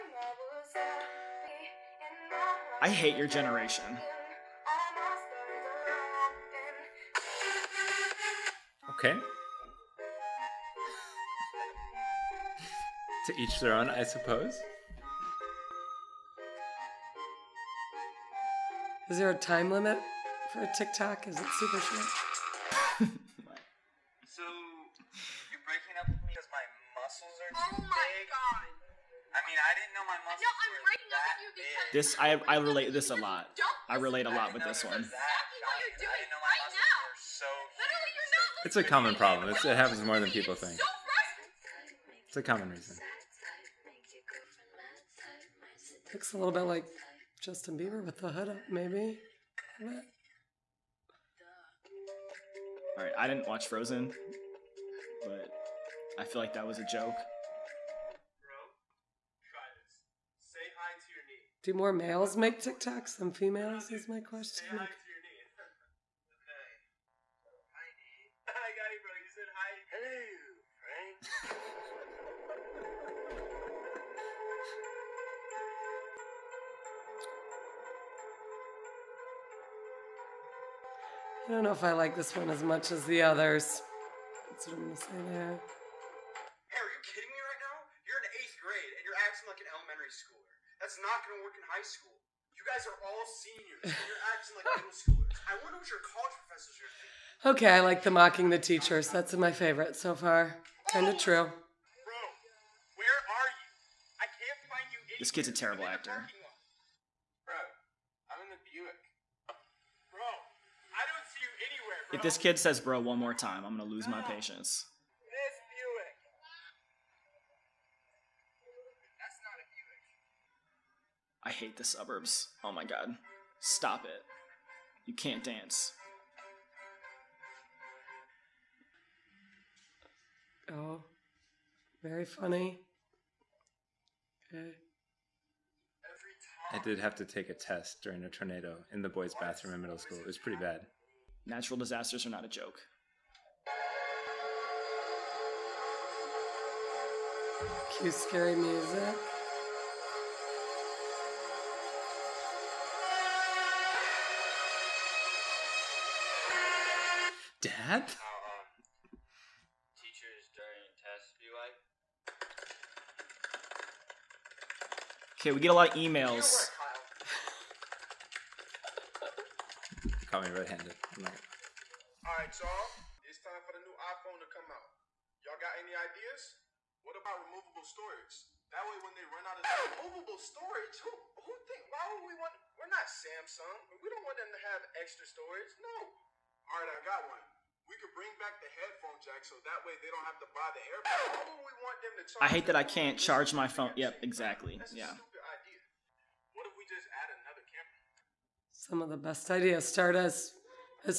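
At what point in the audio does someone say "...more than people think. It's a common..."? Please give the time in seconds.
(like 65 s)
40 s.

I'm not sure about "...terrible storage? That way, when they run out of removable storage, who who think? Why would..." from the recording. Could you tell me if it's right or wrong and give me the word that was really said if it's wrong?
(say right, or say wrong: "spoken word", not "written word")
wrong: "removable", not "terrible".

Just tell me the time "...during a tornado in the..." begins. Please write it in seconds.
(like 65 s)
138 s.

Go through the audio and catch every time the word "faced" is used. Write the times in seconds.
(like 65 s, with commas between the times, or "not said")
not said.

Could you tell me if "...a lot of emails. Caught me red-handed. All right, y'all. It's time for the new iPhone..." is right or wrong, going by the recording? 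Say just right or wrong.
right.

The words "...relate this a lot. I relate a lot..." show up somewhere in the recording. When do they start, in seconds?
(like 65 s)
32 s.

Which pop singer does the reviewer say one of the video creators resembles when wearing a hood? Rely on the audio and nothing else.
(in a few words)
Justin Bieber.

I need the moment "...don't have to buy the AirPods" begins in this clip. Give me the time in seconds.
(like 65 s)
190 s.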